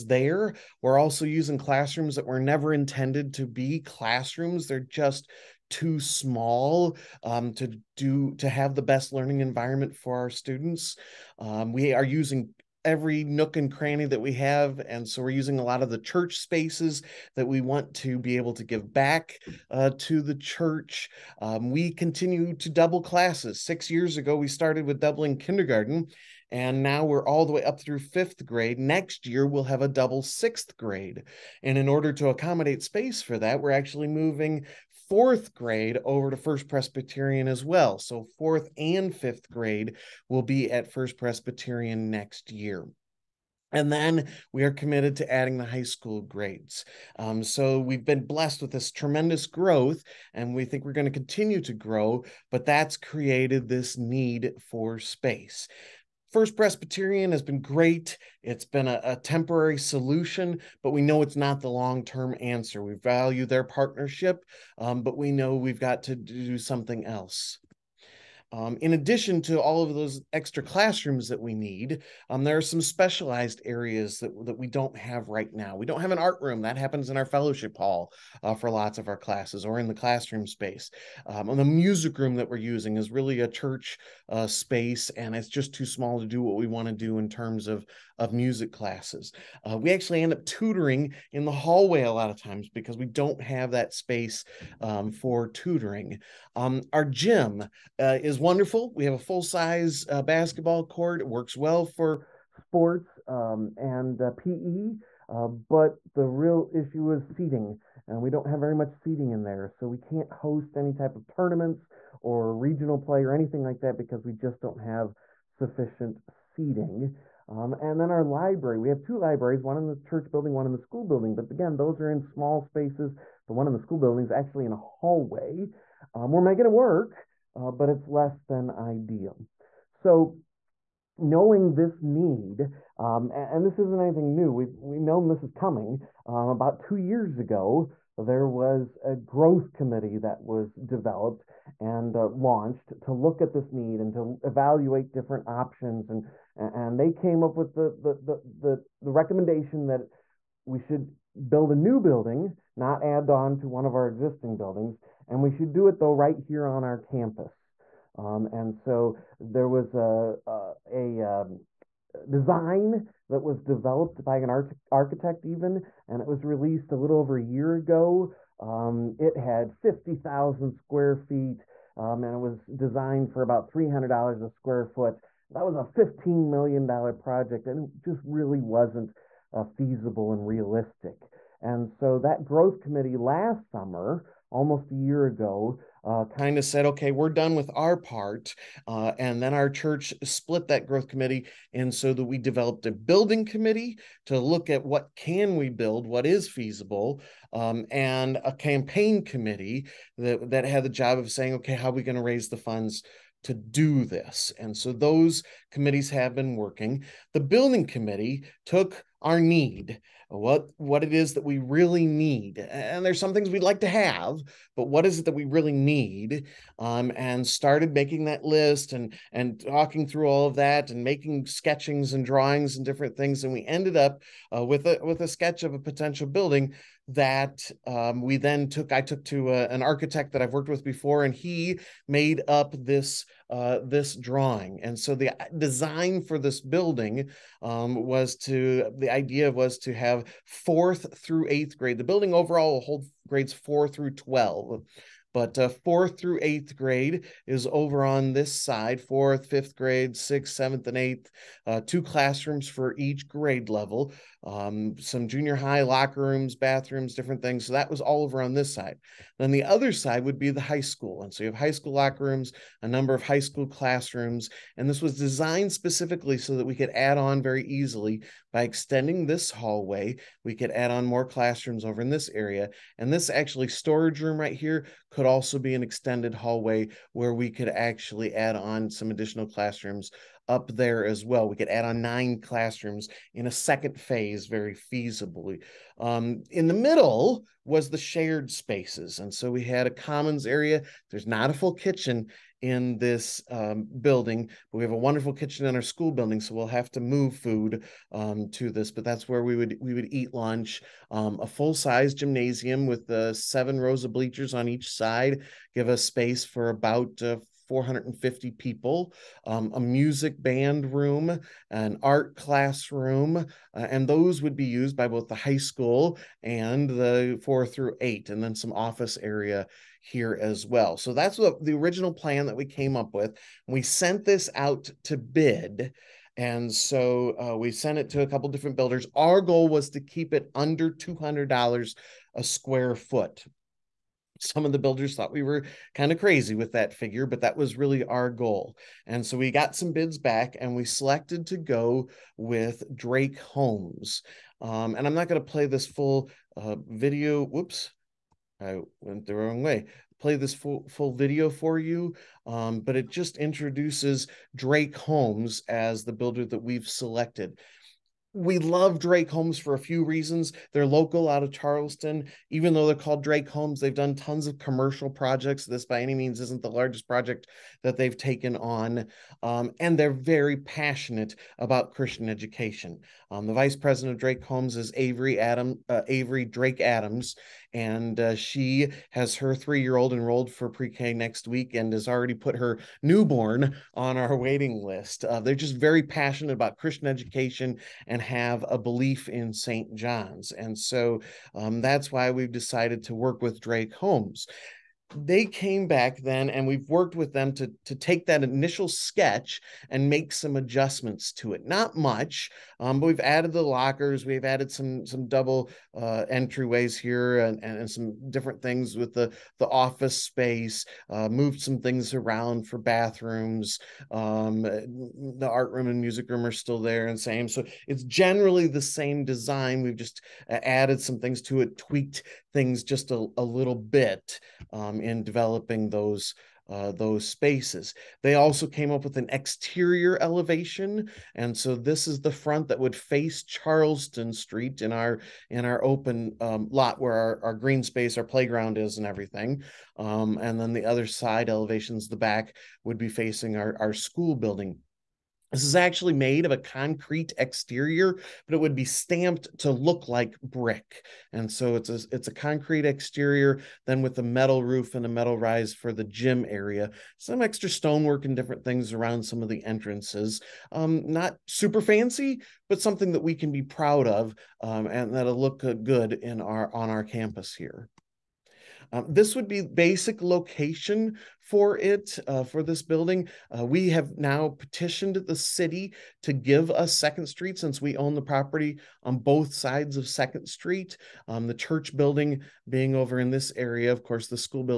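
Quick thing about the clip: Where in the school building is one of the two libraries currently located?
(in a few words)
In a hallway.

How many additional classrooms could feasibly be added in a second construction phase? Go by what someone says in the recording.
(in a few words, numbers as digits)
9.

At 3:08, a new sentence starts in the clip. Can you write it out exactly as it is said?
Uh, and then our church split that growth committee.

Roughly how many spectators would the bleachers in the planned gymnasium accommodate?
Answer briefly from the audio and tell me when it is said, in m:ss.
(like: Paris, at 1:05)
450, at 5:07.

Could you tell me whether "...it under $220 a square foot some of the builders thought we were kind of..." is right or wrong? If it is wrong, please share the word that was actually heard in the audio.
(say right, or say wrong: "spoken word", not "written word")
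wrong: "200", not "220".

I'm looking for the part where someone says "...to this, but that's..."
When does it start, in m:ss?
4:58.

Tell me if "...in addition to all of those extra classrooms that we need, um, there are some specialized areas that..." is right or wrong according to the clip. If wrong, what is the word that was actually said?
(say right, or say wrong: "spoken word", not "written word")
right.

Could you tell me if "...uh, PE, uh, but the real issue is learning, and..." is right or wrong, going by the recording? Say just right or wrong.
wrong.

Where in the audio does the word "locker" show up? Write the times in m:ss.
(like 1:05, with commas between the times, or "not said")
4:15, 4:21, 6:43.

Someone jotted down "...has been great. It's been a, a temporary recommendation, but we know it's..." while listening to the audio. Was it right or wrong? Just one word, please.
wrong.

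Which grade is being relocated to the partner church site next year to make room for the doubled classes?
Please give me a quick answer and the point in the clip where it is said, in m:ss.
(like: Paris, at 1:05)
Fourth grade, at 0:35.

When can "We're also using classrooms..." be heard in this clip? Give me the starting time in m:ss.
0:00.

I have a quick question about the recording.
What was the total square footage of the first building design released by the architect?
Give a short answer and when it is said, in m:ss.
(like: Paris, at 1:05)
50000, at 2:49.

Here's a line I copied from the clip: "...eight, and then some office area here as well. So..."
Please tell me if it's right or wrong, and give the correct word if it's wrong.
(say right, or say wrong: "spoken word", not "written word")
right.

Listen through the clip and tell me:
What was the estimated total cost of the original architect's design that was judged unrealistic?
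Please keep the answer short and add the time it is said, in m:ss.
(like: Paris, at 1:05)
$15 million, at 2:55.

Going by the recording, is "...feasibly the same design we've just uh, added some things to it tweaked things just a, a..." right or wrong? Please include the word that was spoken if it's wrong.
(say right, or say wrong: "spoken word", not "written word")
wrong: "generally", not "feasibly".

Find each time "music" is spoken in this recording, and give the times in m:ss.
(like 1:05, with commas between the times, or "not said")
1:21, 1:28, 5:09, 6:56.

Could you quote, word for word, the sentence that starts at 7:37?
Some extra stonework and different things around some of the entrances.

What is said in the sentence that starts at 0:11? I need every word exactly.
Um, we are using every nook and cranny that we have.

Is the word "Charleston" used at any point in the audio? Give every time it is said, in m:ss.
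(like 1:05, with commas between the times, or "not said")
6:01, 7:13.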